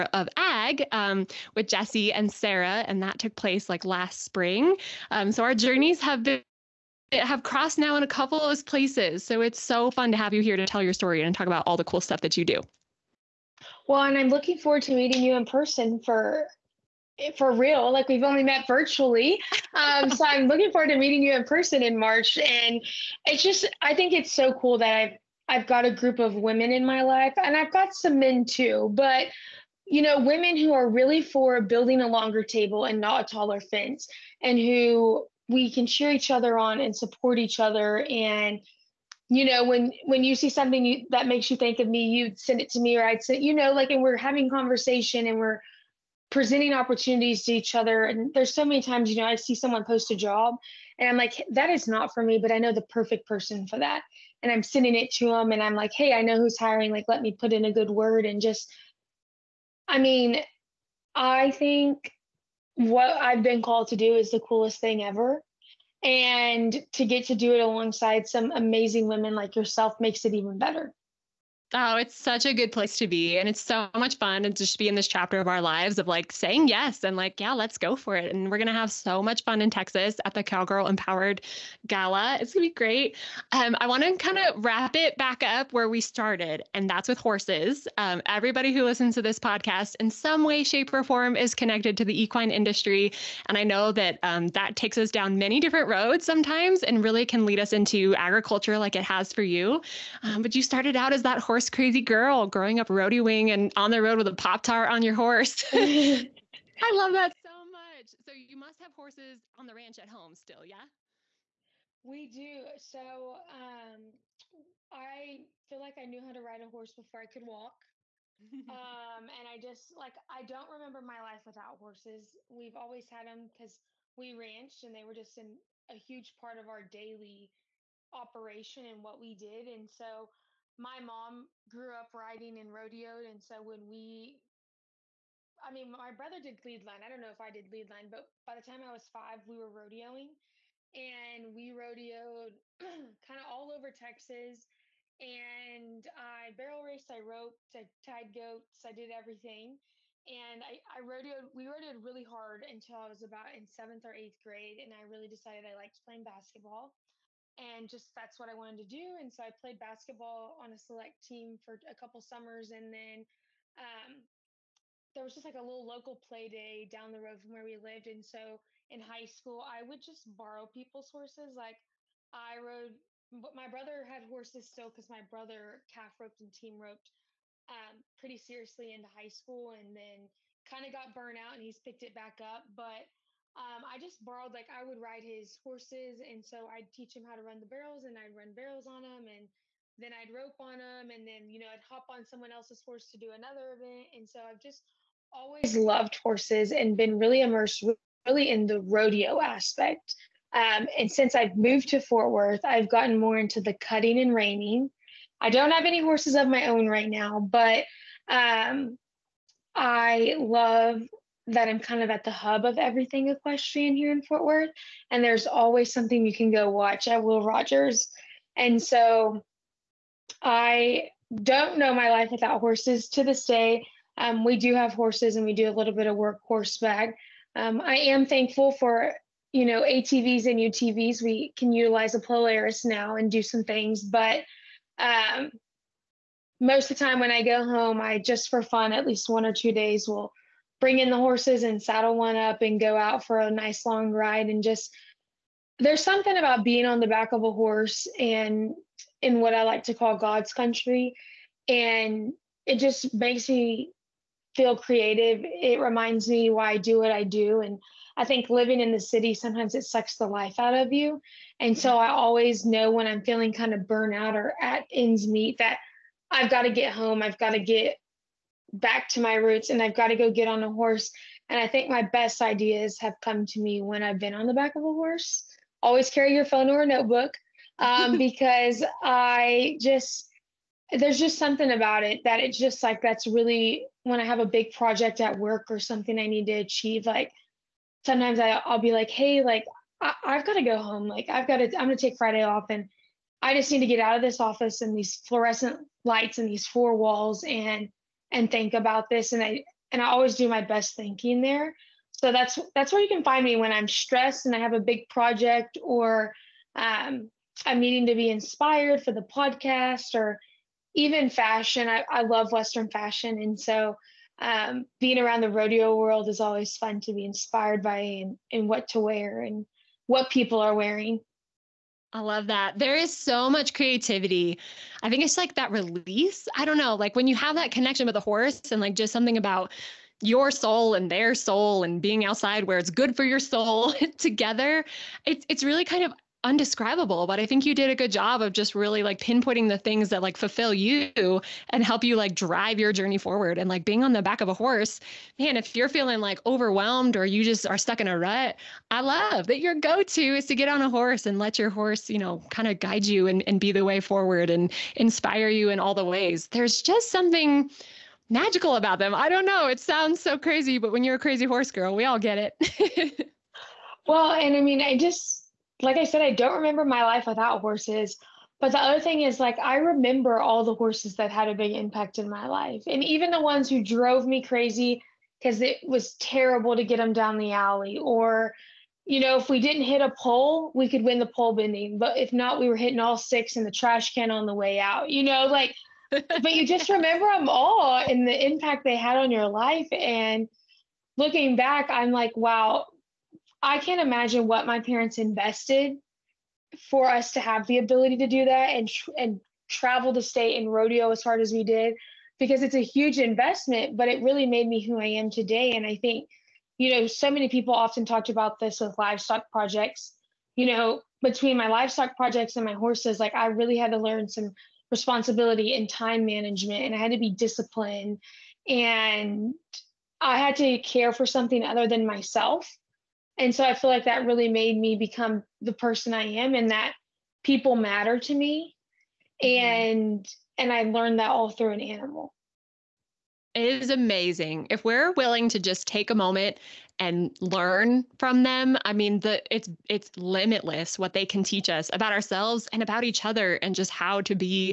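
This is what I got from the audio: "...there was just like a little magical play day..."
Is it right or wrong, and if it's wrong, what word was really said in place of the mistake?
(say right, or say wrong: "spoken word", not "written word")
wrong: "local", not "magical".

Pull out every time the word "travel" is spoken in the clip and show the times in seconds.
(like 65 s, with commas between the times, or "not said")
399 s.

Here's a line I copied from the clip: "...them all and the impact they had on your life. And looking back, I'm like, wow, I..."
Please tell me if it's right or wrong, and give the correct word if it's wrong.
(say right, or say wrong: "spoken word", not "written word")
right.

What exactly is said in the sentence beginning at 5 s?
Um, so our journeys have been have crossed now in a couple of places.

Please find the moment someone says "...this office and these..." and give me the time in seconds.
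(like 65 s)
294 s.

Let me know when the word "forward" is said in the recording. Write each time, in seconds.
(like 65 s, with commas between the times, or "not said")
14 s, 20 s, 343 s, 353 s.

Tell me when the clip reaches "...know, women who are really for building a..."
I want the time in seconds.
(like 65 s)
30 s.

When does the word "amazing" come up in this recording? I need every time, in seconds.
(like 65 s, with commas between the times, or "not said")
68 s, 433 s.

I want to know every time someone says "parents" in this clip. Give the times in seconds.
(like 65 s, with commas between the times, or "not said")
394 s.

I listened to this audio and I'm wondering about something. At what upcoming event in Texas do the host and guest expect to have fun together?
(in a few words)
Cowgirl Empowered Gala.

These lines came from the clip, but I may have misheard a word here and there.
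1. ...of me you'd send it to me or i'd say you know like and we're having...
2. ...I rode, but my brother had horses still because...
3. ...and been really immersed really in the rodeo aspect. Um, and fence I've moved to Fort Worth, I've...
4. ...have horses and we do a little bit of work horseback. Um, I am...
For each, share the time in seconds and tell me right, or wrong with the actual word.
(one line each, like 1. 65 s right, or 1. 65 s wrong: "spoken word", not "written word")
1. 41 s right
2. 172 s right
3. 196 s wrong: "since", not "fence"
4. 224 s right.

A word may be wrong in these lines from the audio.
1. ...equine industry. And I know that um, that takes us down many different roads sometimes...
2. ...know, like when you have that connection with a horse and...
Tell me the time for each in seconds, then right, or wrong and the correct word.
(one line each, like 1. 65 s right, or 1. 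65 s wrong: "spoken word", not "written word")
1. 92 s right
2. 326 s right.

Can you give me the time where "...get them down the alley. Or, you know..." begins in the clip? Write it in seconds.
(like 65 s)
376 s.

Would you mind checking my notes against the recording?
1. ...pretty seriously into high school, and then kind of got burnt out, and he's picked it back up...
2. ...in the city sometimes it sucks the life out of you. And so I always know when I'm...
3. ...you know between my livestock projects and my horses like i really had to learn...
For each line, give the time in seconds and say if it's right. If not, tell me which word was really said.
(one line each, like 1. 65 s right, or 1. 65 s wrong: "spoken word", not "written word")
1. 178 s right
2. 258 s right
3. 410 s right.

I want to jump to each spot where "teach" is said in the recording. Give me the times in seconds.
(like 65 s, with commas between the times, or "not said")
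186 s, 441 s.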